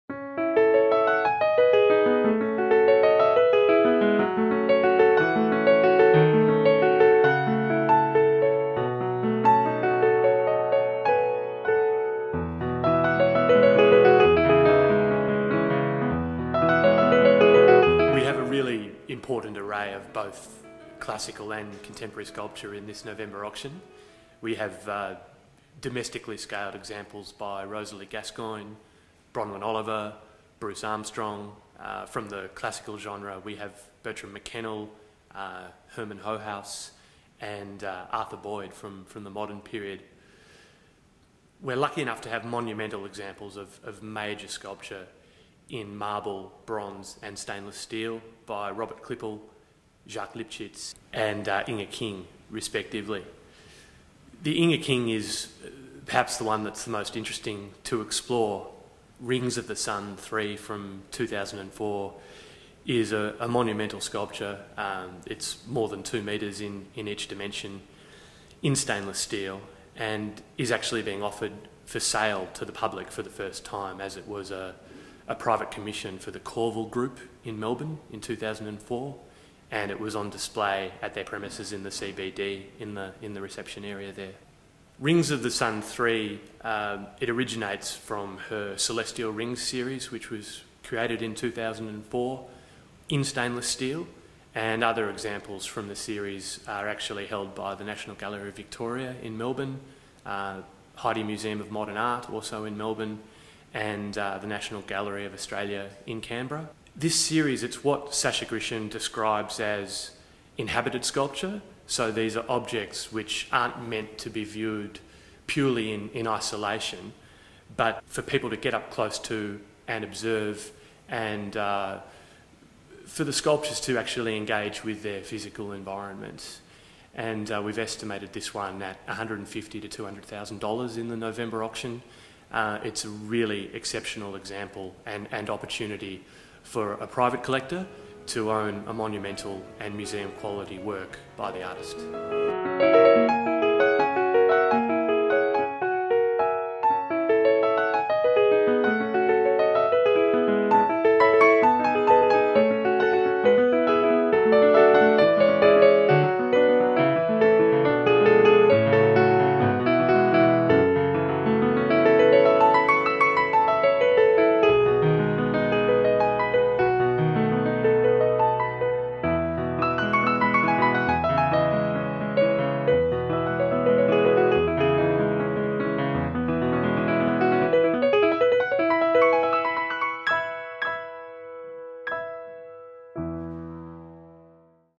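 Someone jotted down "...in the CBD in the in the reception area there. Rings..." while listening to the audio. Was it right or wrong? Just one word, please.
right.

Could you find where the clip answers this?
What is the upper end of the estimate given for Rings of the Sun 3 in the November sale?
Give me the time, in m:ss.
2:10.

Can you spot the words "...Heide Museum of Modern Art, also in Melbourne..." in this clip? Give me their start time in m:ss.
1:40.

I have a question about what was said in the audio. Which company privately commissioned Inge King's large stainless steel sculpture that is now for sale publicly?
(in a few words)
Corval Group.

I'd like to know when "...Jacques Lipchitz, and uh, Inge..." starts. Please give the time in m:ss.
0:50.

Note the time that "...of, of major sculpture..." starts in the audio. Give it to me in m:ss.
0:43.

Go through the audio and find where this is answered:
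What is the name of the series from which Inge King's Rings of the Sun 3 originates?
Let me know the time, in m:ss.
1:28.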